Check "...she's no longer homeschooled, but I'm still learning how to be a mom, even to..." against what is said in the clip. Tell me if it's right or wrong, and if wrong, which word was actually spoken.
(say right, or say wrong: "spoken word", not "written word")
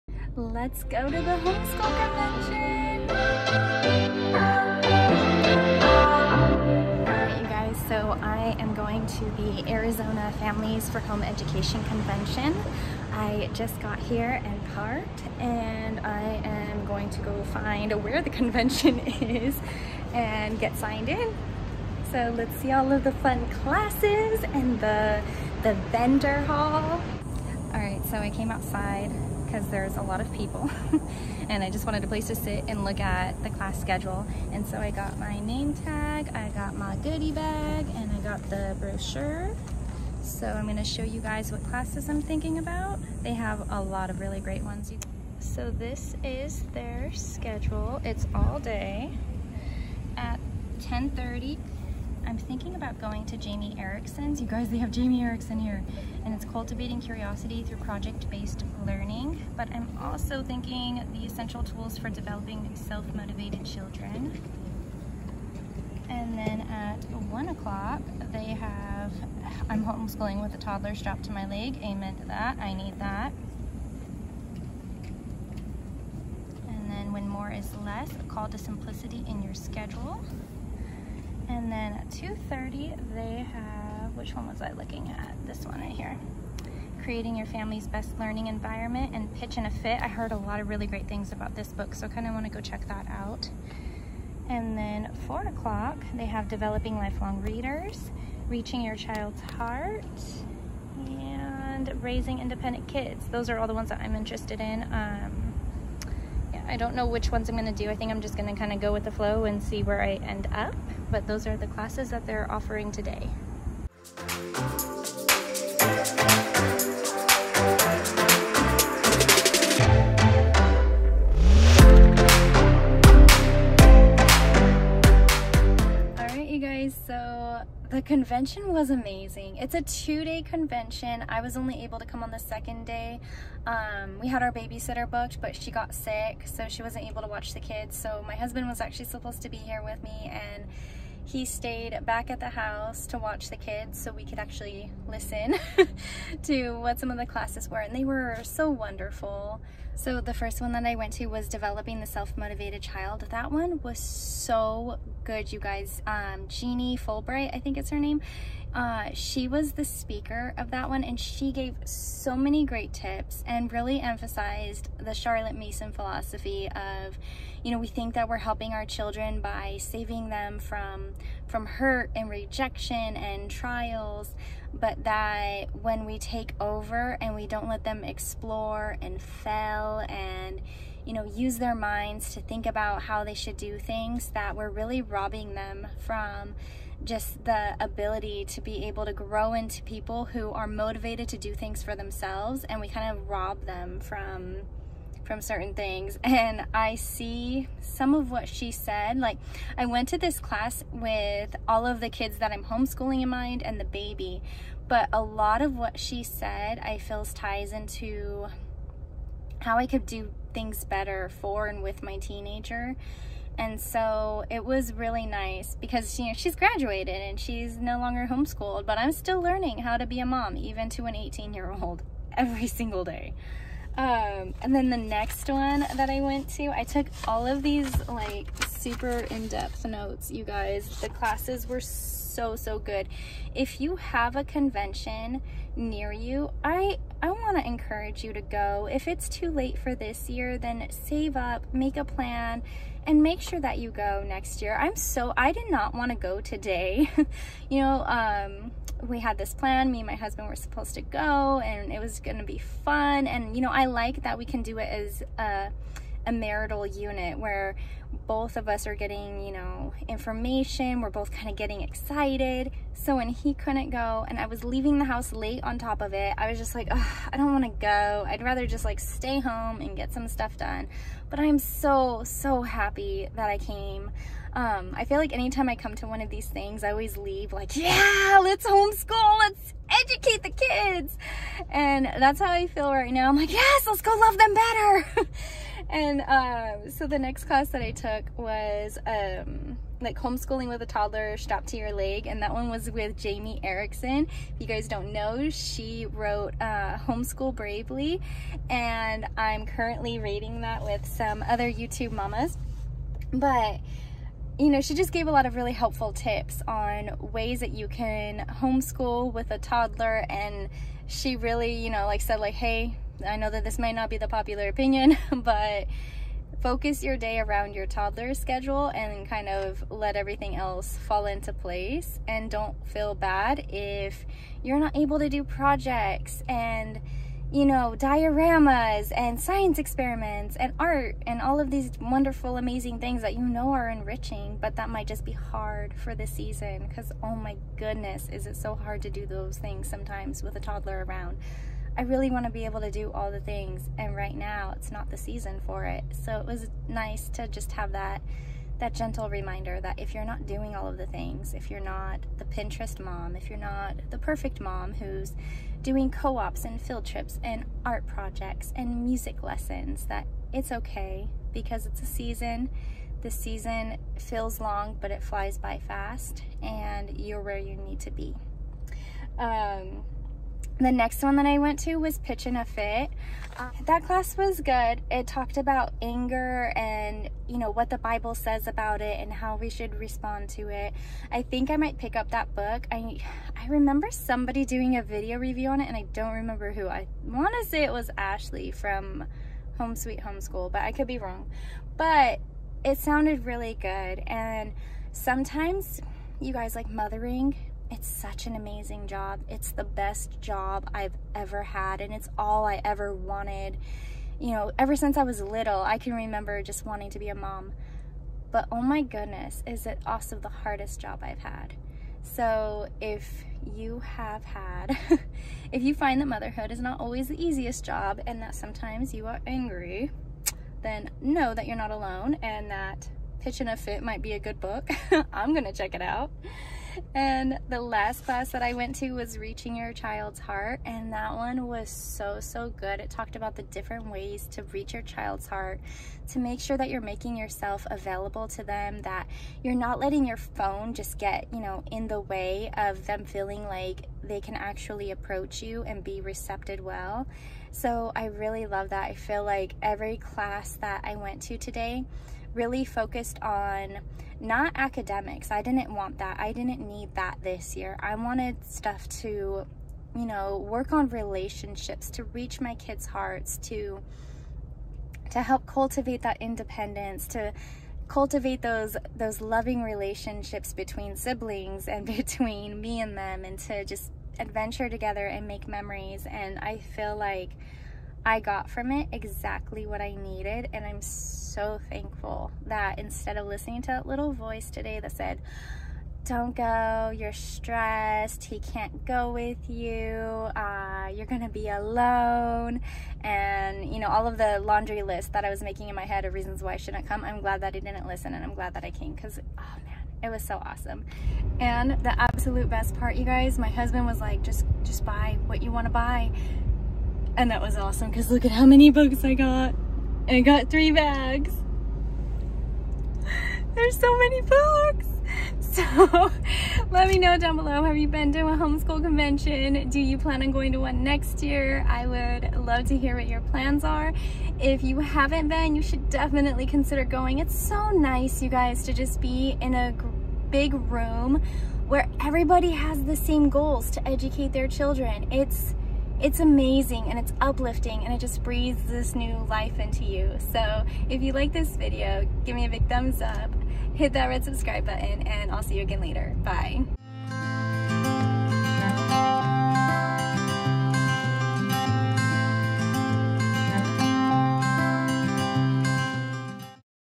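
right.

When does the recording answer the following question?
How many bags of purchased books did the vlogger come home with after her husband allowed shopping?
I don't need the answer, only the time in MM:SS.
08:30.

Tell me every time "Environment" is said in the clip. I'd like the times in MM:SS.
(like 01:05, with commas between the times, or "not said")
01:28.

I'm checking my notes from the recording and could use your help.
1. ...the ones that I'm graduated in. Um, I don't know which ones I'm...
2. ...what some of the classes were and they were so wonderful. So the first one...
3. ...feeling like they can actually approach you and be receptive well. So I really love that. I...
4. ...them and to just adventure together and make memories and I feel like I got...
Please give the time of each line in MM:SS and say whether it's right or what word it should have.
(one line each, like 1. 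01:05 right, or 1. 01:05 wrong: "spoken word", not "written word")
1. 01:43 wrong: "interested", not "graduated"
2. 02:26 right
3. 07:23 right
4. 07:53 right.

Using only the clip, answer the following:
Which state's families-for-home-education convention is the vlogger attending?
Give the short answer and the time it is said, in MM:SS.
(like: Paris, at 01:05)
Arizona, at 00:09.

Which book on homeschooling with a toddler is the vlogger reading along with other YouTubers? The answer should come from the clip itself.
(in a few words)
Homeschool Bravely.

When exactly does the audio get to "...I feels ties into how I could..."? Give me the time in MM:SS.
03:26.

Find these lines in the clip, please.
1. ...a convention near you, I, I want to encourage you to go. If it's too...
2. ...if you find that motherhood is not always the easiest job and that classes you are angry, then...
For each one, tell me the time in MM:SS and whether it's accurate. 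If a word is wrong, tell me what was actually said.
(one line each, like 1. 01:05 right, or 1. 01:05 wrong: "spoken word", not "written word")
1. 03:54 right
2. 06:55 wrong: "sometimes", not "classes".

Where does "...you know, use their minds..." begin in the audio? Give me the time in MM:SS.
03:01.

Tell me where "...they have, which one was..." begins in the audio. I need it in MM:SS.
01:23.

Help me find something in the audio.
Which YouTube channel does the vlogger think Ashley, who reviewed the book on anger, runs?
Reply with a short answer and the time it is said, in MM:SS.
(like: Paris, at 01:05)
Home Sweet Homeschool, at 06:29.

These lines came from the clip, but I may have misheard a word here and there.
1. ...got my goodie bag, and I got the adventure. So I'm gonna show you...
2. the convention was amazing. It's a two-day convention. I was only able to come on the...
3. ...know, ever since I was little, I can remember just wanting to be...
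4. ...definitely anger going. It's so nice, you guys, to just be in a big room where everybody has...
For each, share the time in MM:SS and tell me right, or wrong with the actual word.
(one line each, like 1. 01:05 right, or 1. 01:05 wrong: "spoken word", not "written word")
1. 00:36 wrong: "brochure", not "adventure"
2. 02:07 right
3. 06:44 right
4. 08:46 wrong: "consider", not "anger".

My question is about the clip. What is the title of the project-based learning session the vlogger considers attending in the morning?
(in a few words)
Cultivating Curiosity.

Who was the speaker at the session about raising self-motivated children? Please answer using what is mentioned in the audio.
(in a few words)
Jeannie Fulbright.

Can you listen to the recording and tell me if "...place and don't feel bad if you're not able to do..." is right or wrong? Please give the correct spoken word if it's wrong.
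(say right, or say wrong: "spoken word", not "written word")
right.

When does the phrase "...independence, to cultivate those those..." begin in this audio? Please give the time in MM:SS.
07:46.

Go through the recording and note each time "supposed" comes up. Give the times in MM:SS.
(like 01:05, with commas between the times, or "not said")
02:19, 04:10.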